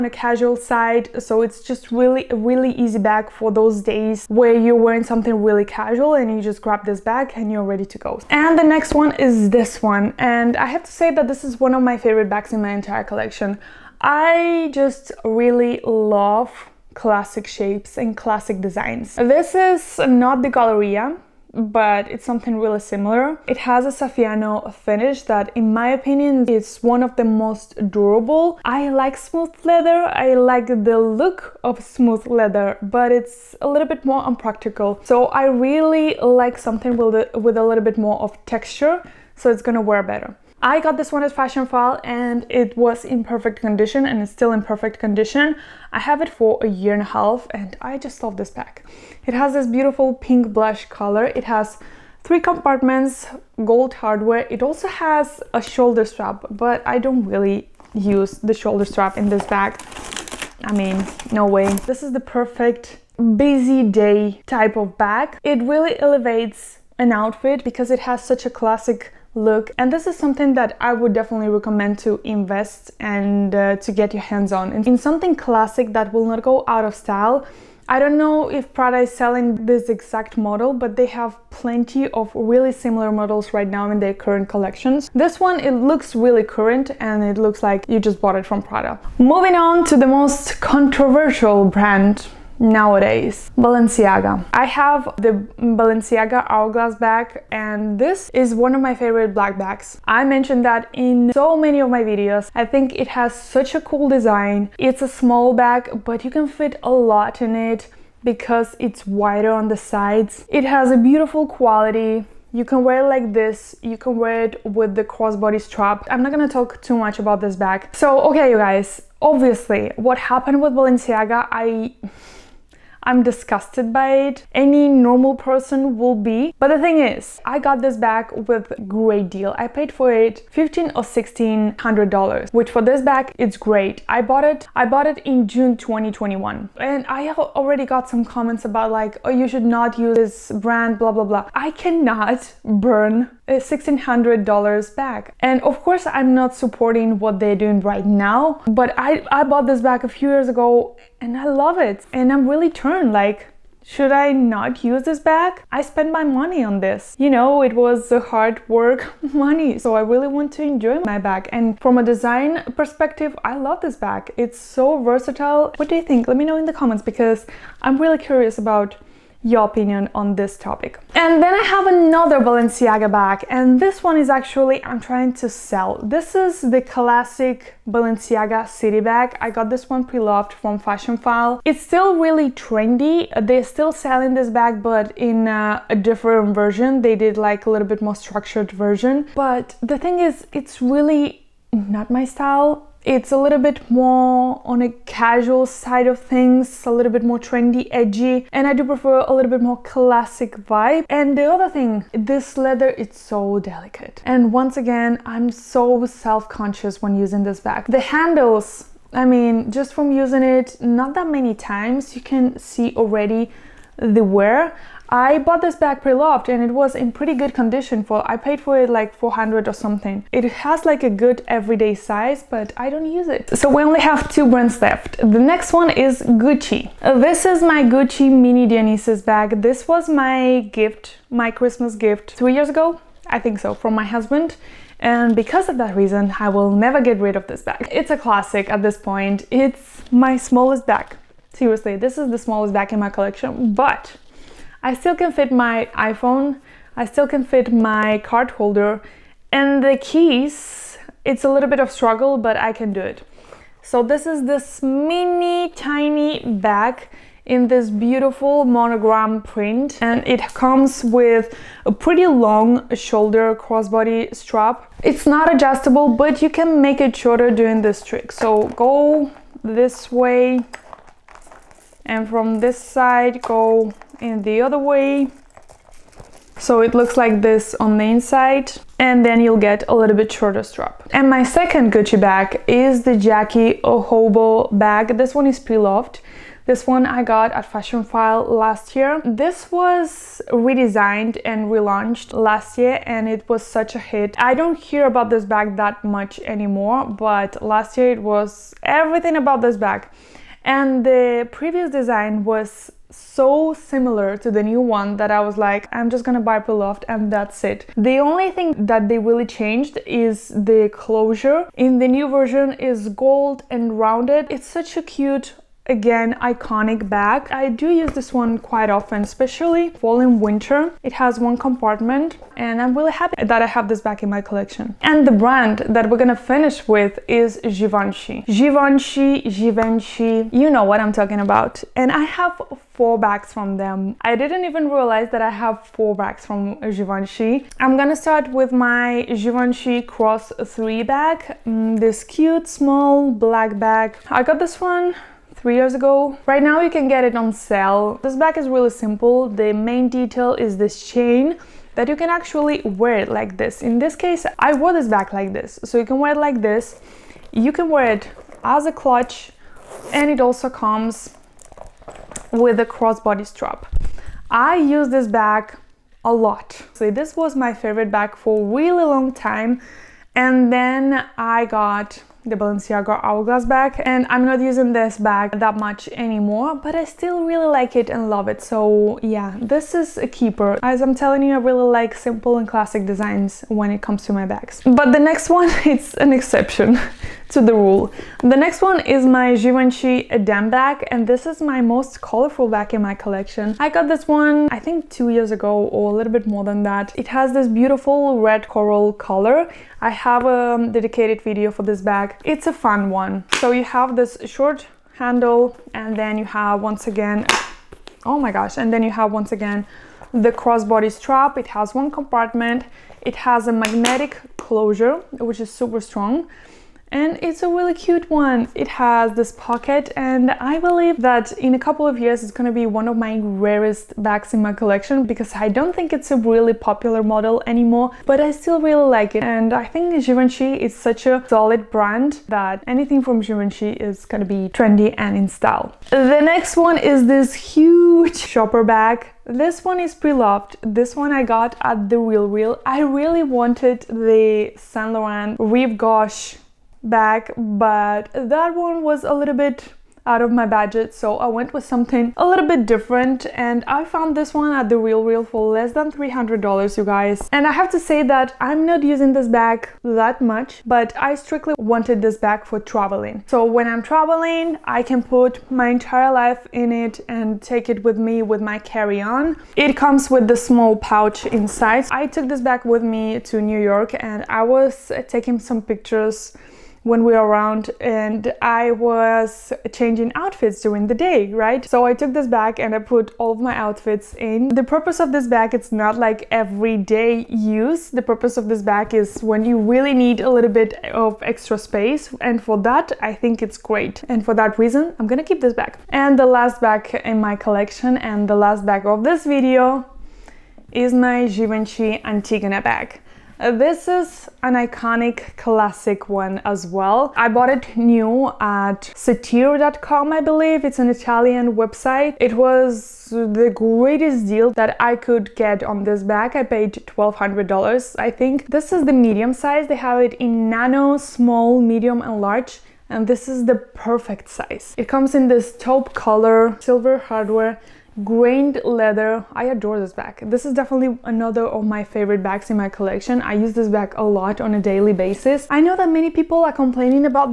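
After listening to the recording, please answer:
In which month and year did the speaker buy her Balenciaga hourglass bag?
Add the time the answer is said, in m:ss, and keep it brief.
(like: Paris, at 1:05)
June 2021, at 2:15.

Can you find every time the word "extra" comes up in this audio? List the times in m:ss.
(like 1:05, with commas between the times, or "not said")
8:11.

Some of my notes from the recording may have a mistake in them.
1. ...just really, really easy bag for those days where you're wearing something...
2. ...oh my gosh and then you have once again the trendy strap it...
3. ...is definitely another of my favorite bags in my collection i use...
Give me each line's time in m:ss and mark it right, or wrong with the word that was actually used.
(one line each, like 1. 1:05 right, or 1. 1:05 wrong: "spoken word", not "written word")
1. 0:01 right
2. 6:48 wrong: "crossbody", not "trendy"
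3. 8:50 right.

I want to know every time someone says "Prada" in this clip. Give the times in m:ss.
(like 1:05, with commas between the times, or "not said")
1:18, 1:28.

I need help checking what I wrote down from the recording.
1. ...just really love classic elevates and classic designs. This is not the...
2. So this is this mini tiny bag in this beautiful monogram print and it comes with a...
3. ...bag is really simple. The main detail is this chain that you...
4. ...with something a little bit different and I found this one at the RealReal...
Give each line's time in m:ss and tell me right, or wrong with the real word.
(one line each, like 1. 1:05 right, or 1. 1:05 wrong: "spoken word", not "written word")
1. 0:14 wrong: "shapes", not "elevates"
2. 4:13 right
3. 5:48 right
4. 7:31 right.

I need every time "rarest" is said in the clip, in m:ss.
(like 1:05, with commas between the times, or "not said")
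7:03.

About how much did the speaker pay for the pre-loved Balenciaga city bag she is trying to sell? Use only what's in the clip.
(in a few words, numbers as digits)
400.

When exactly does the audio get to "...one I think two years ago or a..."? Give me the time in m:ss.
6:34.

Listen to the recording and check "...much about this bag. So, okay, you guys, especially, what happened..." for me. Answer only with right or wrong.
wrong.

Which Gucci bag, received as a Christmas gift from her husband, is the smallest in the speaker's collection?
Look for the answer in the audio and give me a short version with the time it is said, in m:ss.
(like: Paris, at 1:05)
Mini Dionysus, at 3:48.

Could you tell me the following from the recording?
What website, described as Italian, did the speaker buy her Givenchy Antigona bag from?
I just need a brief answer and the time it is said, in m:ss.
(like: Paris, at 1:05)
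satiro.com, at 8:29.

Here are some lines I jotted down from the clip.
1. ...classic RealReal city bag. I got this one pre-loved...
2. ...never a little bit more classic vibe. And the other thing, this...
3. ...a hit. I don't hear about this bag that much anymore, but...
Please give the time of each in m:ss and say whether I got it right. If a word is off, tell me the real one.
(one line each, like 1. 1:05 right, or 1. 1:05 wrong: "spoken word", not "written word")
1. 2:56 wrong: "Balenciaga", not "RealReal"
2. 3:18 wrong: "prefer", not "never"
3. 4:53 right.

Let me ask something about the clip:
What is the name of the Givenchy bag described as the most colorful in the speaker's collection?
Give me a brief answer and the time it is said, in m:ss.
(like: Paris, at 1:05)
Eden, at 6:30.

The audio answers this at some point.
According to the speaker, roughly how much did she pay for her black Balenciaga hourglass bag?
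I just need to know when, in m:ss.
2:11.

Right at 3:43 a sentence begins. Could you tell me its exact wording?
So we only have two brands left.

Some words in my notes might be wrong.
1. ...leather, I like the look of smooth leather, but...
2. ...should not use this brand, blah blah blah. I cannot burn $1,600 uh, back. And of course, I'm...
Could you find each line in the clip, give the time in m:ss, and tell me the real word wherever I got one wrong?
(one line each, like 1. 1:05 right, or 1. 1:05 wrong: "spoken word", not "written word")
1. 0:29 right
2. 2:19 right.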